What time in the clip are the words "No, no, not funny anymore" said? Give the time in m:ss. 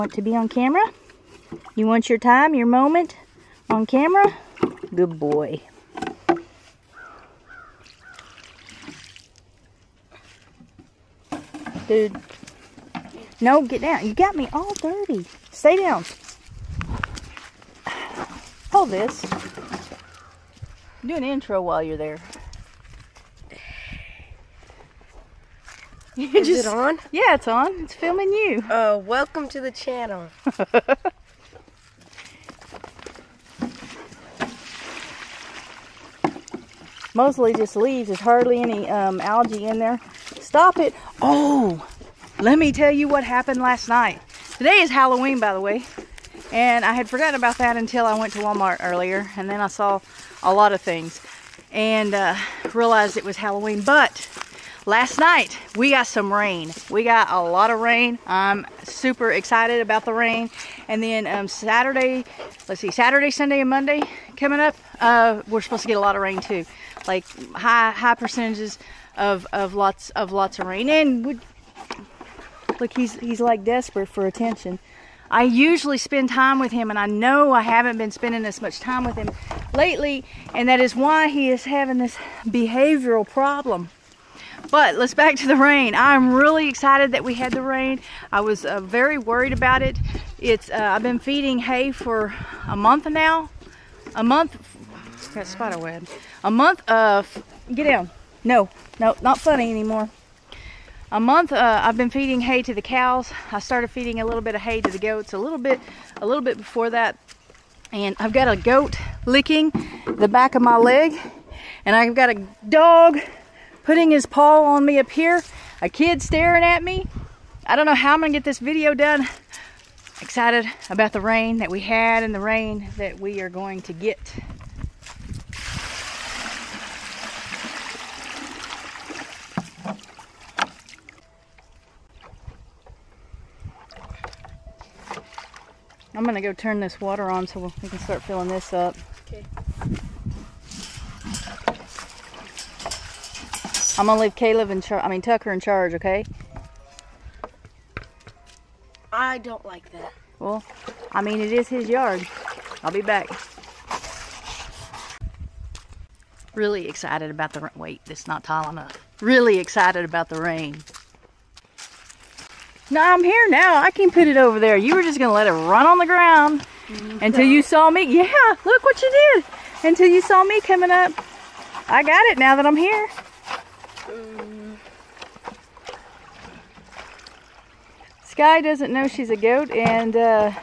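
1:38.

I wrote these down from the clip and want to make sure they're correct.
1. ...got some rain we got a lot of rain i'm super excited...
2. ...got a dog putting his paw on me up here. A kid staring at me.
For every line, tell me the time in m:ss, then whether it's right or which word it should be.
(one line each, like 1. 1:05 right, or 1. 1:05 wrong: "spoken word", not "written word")
1. 0:55 right
2. 1:52 right.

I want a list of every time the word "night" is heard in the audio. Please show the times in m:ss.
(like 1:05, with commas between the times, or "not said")
0:43, 0:55.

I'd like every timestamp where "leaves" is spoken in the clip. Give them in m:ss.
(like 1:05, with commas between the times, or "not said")
0:37, 2:24.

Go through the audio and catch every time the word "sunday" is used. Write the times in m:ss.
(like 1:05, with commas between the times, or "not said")
1:03.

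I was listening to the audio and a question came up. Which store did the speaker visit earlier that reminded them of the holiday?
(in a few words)
Walmart.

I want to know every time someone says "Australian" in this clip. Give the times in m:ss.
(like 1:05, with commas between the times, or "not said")
not said.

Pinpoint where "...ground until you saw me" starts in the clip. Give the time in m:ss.
2:46.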